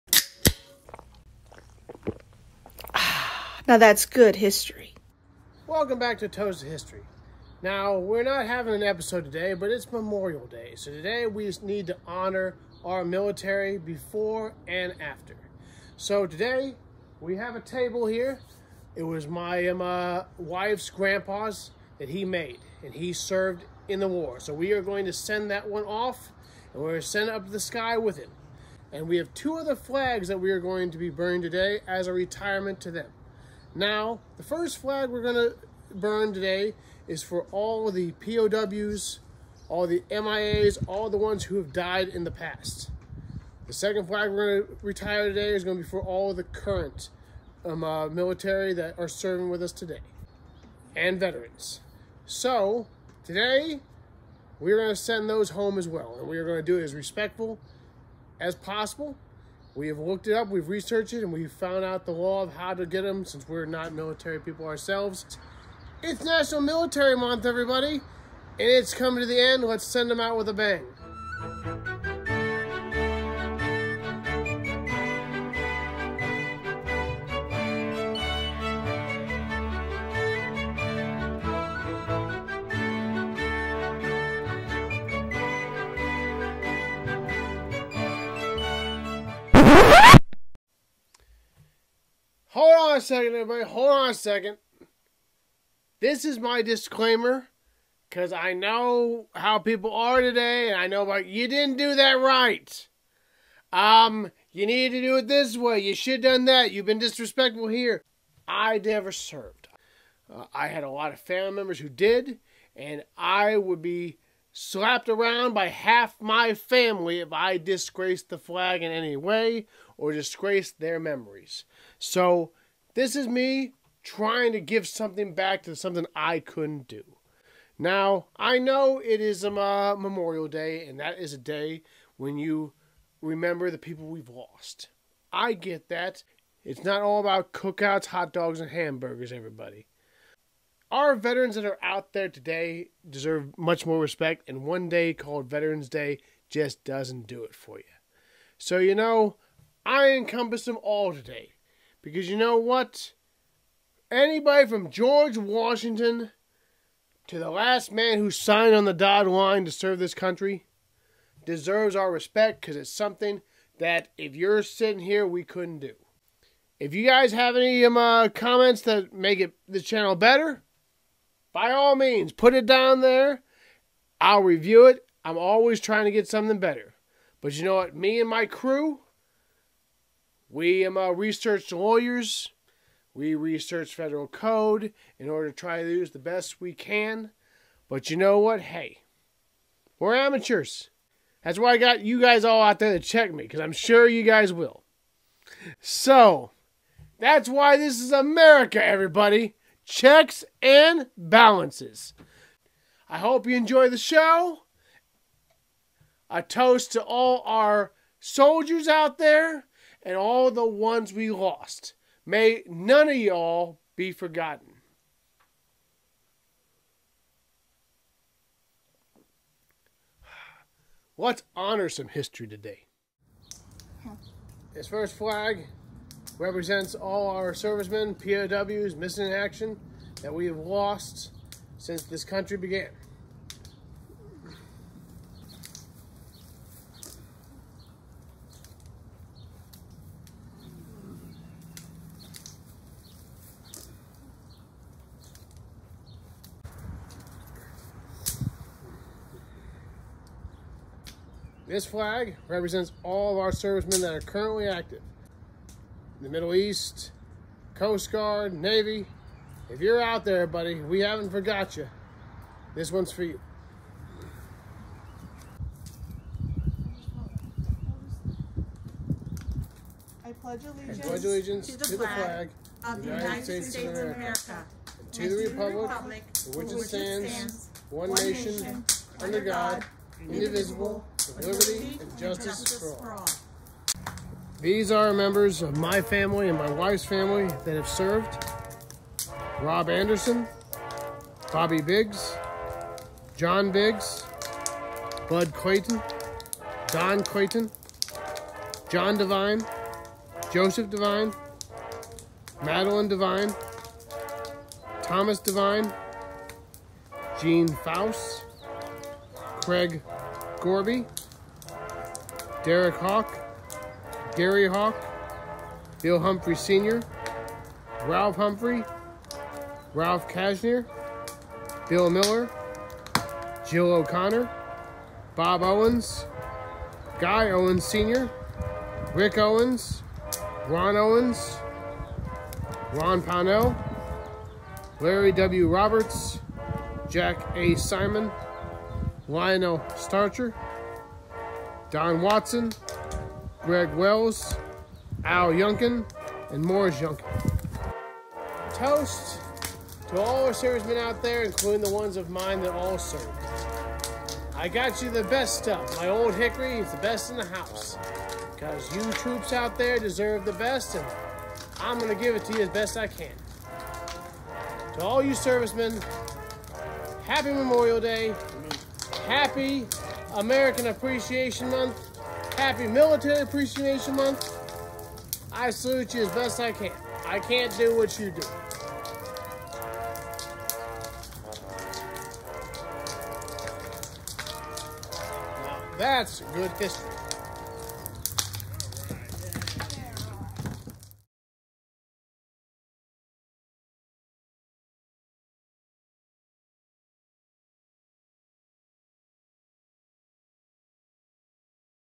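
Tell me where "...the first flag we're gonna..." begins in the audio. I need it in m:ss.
0:34.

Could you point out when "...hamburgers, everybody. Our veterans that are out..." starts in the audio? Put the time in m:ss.
2:18.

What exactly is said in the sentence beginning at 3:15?
So, that's why this is America, everybody.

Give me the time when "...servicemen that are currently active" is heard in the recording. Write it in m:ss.
4:13.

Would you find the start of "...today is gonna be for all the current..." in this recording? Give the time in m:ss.
0:45.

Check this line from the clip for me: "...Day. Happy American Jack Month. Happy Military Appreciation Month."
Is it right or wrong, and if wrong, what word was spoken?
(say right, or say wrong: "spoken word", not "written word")
wrong: "Appreciation", not "Jack".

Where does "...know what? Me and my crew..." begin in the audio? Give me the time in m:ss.
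2:57.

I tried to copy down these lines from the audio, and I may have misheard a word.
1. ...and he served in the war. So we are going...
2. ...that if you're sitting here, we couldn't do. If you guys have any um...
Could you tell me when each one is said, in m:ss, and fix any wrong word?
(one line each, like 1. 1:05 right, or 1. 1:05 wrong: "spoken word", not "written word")
1. 0:22 right
2. 2:43 right.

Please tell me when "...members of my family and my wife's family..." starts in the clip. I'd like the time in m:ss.
4:45.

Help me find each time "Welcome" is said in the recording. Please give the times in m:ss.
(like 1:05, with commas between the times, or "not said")
0:05.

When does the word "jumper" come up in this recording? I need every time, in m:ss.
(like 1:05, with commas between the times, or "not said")
not said.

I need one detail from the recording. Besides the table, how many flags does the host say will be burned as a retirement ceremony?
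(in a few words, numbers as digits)
2.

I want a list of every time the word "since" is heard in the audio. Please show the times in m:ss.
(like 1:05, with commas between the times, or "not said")
1:03, 3:51.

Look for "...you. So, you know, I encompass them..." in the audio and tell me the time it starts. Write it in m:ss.
2:27.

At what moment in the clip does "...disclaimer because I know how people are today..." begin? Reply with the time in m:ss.
1:36.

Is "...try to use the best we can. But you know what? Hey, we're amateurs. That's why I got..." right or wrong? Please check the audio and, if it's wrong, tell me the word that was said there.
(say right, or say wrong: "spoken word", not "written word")
right.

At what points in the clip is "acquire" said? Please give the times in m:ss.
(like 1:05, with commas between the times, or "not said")
not said.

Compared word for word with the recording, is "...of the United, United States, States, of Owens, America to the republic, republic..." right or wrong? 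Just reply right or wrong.
wrong.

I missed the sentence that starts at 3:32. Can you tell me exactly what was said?
May none of y'all be forgotten.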